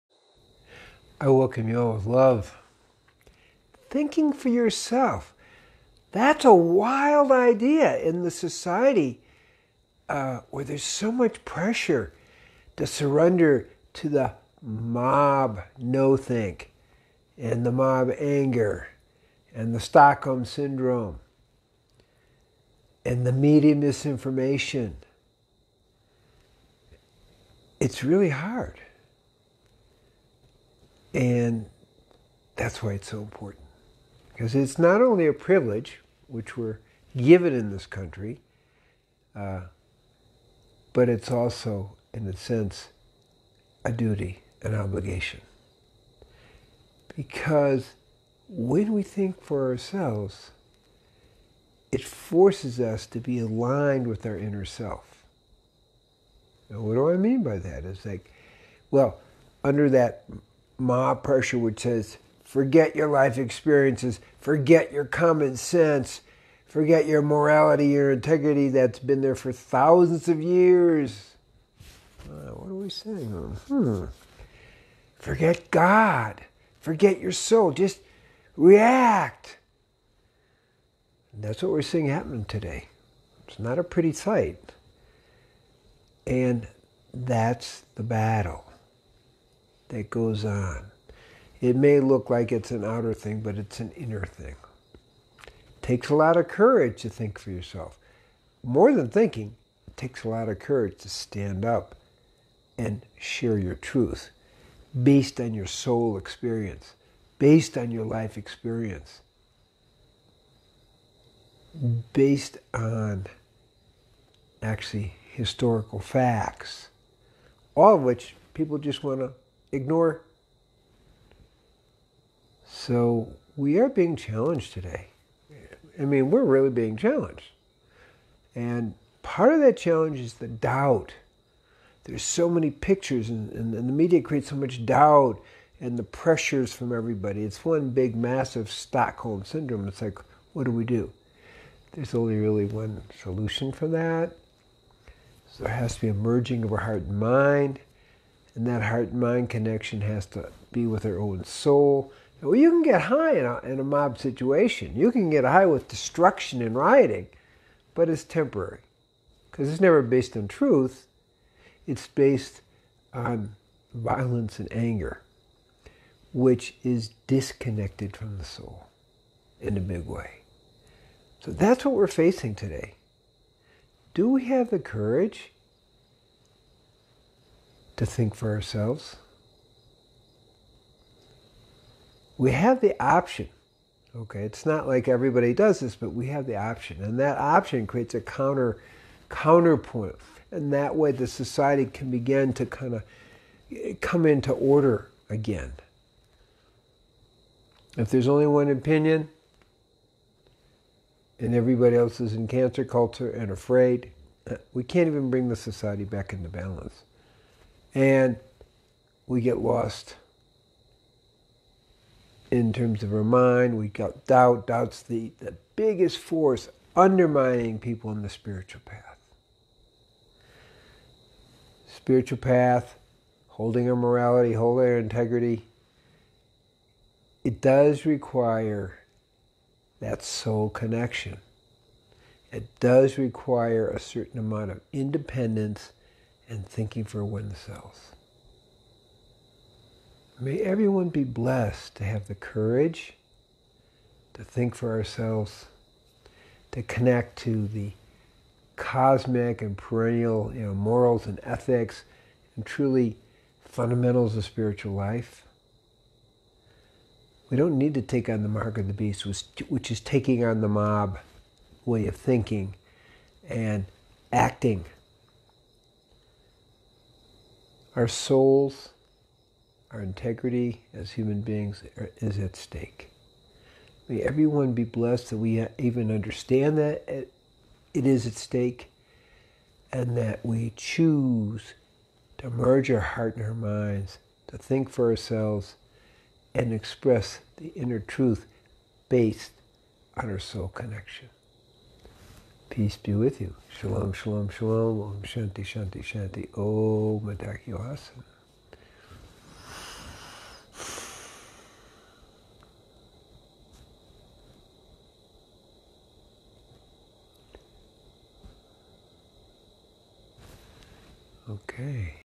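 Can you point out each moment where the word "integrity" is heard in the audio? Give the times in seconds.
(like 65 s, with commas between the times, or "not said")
68 s, 224 s, 270 s.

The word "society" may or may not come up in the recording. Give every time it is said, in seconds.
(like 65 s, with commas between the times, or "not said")
8 s, 191 s, 205 s.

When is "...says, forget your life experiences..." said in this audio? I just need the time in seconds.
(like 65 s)
61 s.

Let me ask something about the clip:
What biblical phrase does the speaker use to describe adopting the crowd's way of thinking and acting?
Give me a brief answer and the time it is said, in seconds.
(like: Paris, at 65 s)
mark of the beast, at 258 s.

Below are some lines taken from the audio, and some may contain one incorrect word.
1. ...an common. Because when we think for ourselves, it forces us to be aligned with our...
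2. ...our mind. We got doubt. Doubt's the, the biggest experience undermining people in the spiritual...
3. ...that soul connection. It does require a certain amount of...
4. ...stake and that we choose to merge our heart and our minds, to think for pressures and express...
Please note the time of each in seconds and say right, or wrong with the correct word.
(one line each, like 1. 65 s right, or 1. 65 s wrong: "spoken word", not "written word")
1. 44 s wrong: "obligation", not "common"
2. 213 s wrong: "force", not "experience"
3. 229 s right
4. 278 s wrong: "ourselves", not "pressures".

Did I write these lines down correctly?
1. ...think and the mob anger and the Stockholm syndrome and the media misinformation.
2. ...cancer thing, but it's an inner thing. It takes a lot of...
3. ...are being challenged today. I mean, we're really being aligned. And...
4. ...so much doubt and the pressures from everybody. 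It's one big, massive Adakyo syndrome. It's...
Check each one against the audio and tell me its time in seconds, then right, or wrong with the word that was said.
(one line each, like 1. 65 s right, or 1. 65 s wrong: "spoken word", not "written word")
1. 16 s right
2. 92 s wrong: "outer", not "cancer"
3. 123 s wrong: "challenged", not "aligned"
4. 134 s wrong: "Stockholm", not "Adakyo".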